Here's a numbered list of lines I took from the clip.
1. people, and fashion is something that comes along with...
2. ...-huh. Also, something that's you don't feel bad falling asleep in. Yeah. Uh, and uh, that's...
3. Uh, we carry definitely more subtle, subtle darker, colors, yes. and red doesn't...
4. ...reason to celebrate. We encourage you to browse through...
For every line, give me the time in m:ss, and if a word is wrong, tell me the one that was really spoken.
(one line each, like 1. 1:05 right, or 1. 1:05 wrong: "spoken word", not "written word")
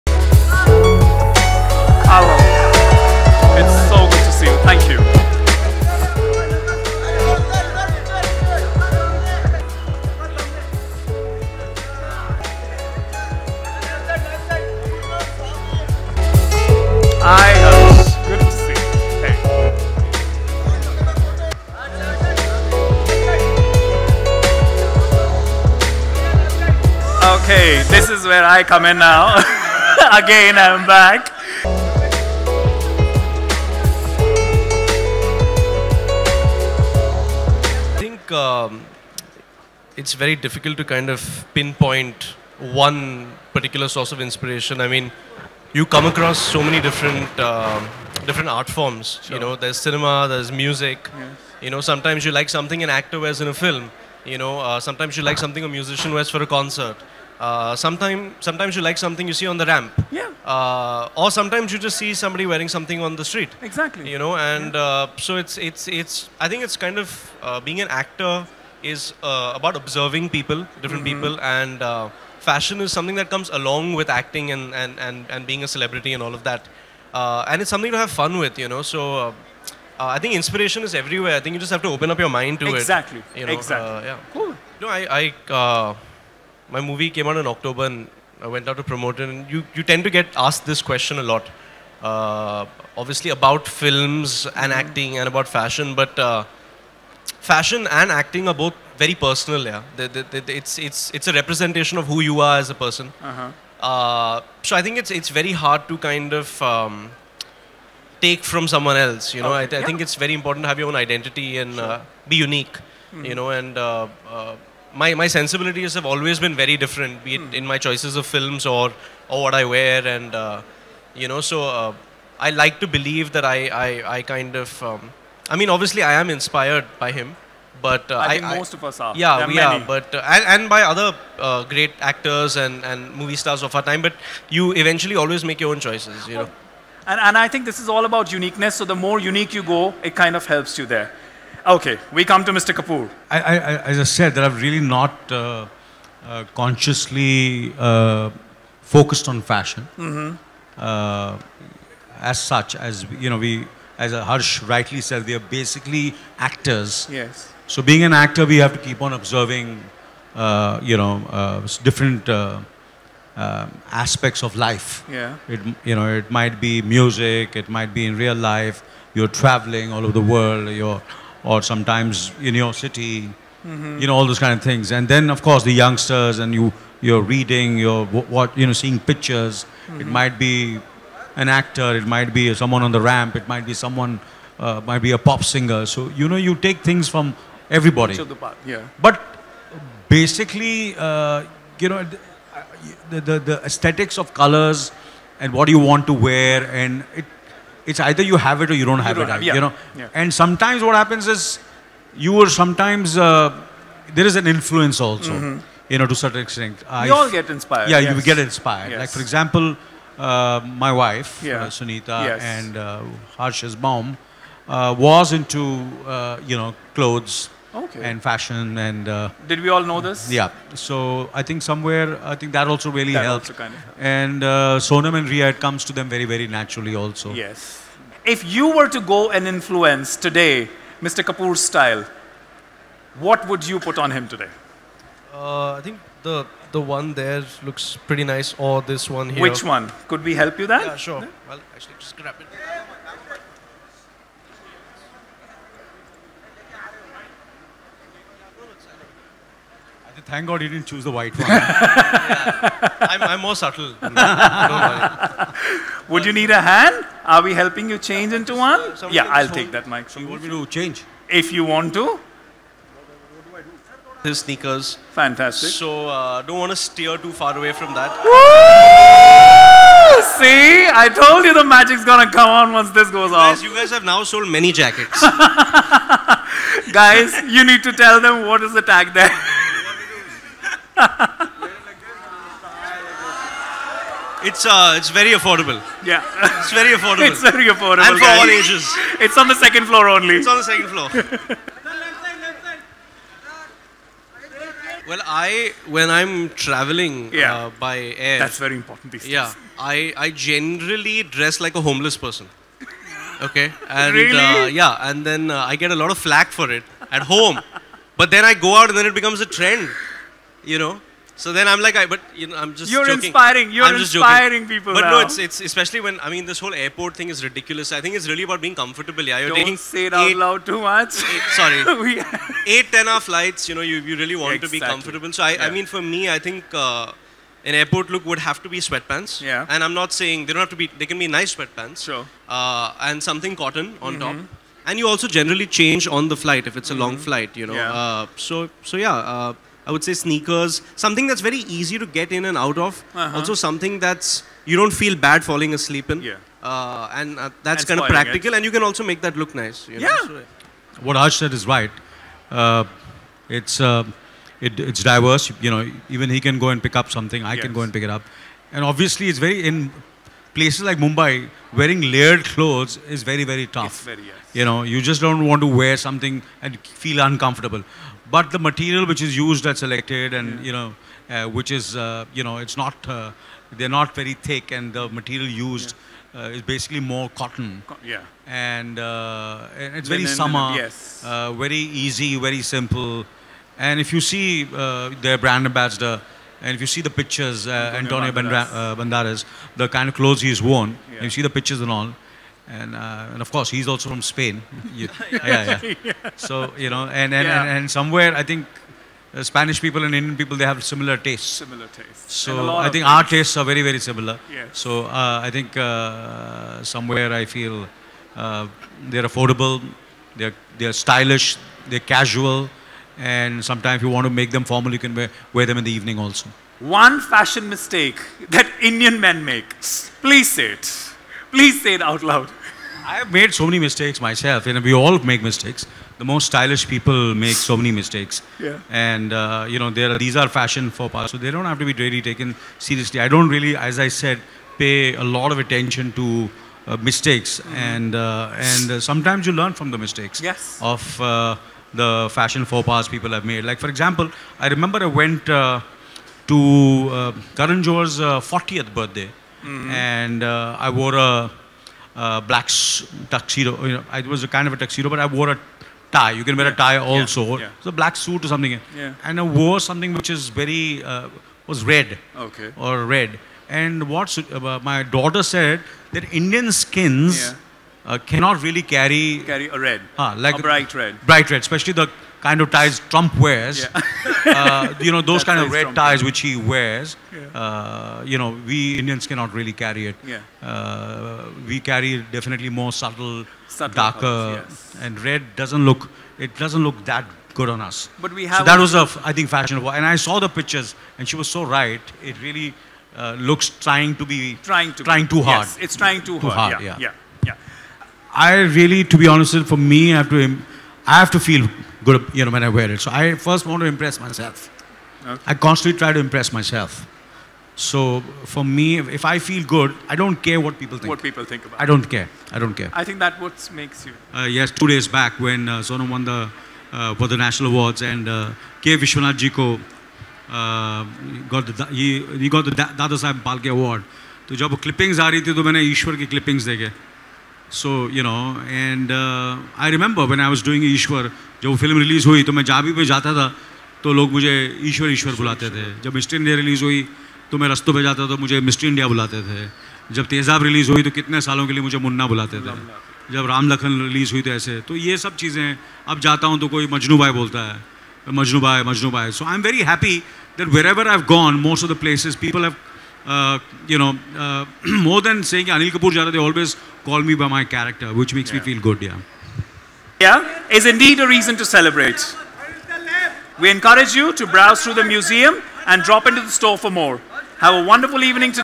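1. 1:11 right
2. 5:43 right
3. 8:00 right
4. 9:21 right.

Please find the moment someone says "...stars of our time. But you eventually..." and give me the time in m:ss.
2:13.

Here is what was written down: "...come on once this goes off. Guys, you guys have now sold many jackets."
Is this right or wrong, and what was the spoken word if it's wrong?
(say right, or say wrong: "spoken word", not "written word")
right.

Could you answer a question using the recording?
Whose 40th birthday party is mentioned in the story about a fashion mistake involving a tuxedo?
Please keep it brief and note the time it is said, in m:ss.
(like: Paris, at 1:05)
Karan Johar, at 7:27.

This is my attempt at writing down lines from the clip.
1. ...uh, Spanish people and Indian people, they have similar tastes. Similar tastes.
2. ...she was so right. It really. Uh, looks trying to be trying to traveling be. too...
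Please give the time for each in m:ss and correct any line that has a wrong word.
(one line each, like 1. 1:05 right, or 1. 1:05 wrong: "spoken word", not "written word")
1. 6:39 right
2. 8:11 wrong: "trying", not "traveling".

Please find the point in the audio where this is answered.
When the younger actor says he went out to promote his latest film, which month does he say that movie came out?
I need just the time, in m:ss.
1:27.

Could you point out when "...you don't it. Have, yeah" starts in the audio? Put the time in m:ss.
3:19.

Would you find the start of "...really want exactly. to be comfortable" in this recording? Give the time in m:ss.
5:24.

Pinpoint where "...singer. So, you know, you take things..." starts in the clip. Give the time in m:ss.
3:05.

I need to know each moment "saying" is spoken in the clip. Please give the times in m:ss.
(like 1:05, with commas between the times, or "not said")
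5:30, 9:15.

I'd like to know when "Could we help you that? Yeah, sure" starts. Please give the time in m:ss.
4:00.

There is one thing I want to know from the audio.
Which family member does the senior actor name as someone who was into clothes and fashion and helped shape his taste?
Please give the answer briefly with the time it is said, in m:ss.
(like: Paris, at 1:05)
Sunita, at 3:31.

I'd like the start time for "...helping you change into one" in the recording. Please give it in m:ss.
4:17.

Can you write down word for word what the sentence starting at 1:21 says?
I think you just have to open up your mind to exactly.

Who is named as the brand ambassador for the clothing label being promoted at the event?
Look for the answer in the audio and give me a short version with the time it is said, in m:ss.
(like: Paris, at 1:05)
Antonio Banderas, at 6:27.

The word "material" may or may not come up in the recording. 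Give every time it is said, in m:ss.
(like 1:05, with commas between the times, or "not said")
6:08, 6:15.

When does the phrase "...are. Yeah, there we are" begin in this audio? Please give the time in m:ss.
2:08.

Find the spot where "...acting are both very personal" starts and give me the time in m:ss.
1:38.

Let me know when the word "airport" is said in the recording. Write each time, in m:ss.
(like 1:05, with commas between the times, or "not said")
5:16, 5:27.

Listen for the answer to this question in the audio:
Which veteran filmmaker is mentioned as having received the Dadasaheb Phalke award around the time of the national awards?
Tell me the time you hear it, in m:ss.
8:38.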